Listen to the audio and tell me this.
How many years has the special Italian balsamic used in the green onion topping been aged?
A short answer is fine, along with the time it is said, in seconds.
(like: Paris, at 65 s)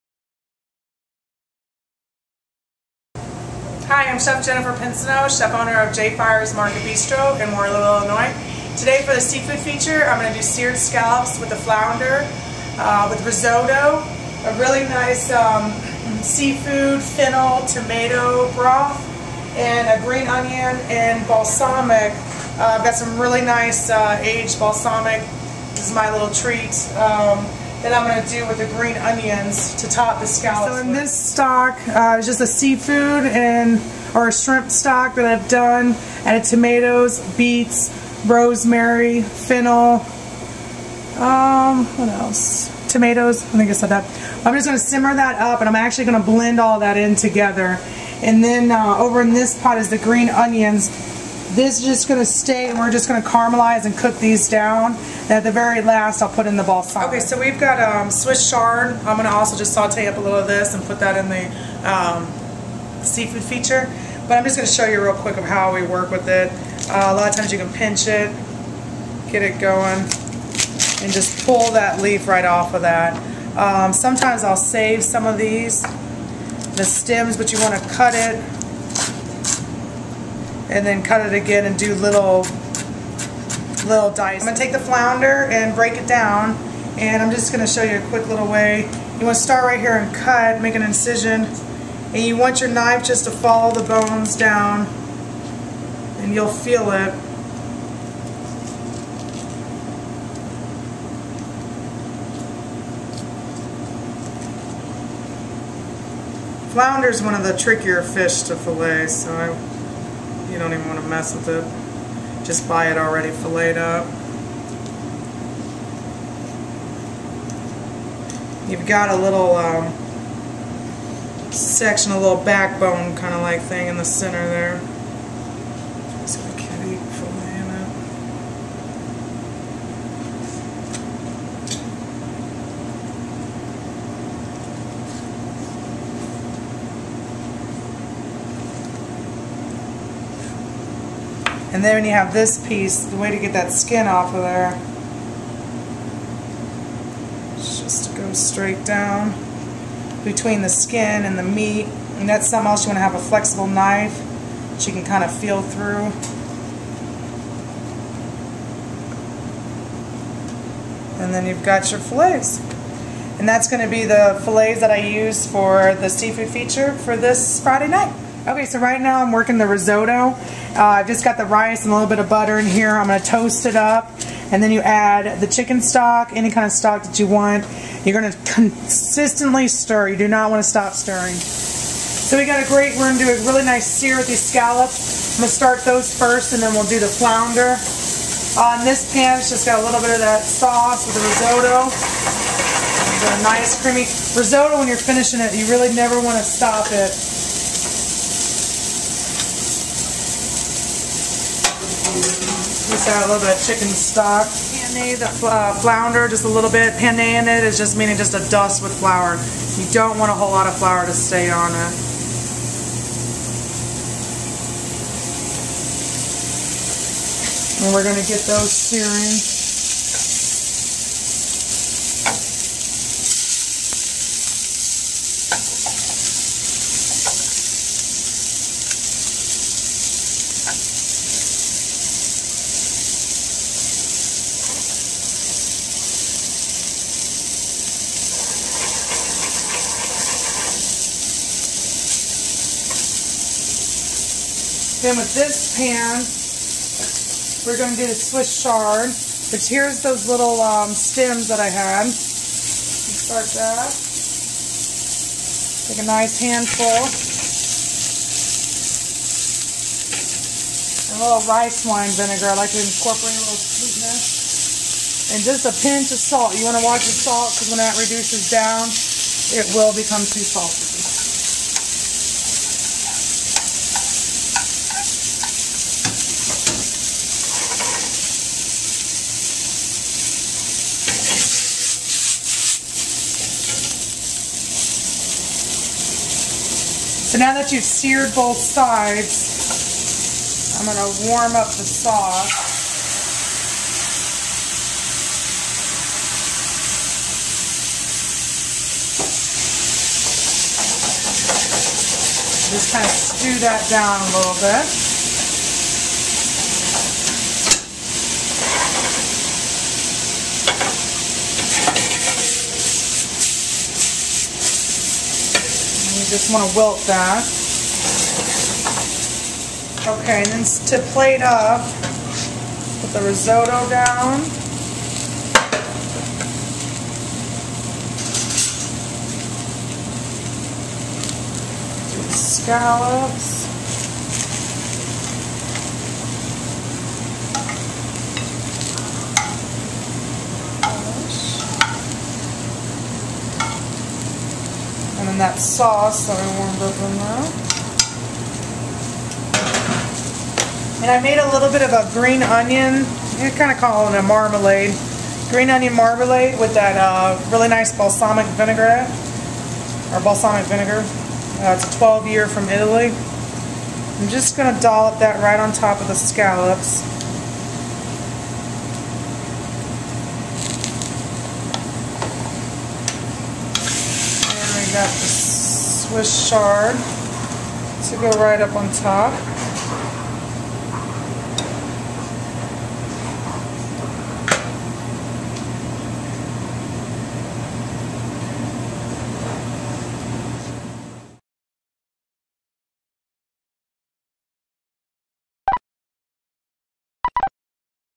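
12, at 361 s.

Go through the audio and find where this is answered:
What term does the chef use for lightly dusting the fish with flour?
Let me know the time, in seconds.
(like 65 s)
206 s.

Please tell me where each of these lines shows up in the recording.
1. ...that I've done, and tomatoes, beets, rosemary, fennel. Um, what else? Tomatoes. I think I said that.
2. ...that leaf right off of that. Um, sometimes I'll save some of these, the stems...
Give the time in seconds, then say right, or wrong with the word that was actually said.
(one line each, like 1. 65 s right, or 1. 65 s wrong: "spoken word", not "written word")
1. 35 s right
2. 71 s right.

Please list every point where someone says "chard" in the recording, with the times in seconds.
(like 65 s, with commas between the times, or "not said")
58 s, 248 s, 376 s.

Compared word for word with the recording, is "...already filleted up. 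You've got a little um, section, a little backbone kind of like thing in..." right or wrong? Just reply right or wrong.
right.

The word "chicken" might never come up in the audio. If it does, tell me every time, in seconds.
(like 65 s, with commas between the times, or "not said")
175 s, 203 s.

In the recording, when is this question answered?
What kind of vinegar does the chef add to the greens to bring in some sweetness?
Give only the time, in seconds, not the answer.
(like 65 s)
261 s.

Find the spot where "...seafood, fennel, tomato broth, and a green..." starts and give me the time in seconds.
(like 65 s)
16 s.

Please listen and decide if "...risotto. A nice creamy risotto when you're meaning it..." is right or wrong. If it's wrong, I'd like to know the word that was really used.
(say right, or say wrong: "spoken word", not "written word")
wrong: "finishing", not "meaning".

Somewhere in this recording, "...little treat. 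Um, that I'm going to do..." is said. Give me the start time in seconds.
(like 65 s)
26 s.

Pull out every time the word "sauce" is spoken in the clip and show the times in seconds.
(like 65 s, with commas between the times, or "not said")
190 s, 291 s, 345 s.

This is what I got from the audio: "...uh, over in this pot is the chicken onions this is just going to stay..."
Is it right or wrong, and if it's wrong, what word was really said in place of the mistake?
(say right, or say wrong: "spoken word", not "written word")
wrong: "green", not "chicken".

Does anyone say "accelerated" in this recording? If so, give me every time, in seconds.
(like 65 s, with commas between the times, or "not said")
not said.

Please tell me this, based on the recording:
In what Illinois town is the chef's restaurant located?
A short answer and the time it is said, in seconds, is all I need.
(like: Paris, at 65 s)
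Waterloo, at 7 s.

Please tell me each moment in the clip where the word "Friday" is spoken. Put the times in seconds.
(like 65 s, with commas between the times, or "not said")
167 s.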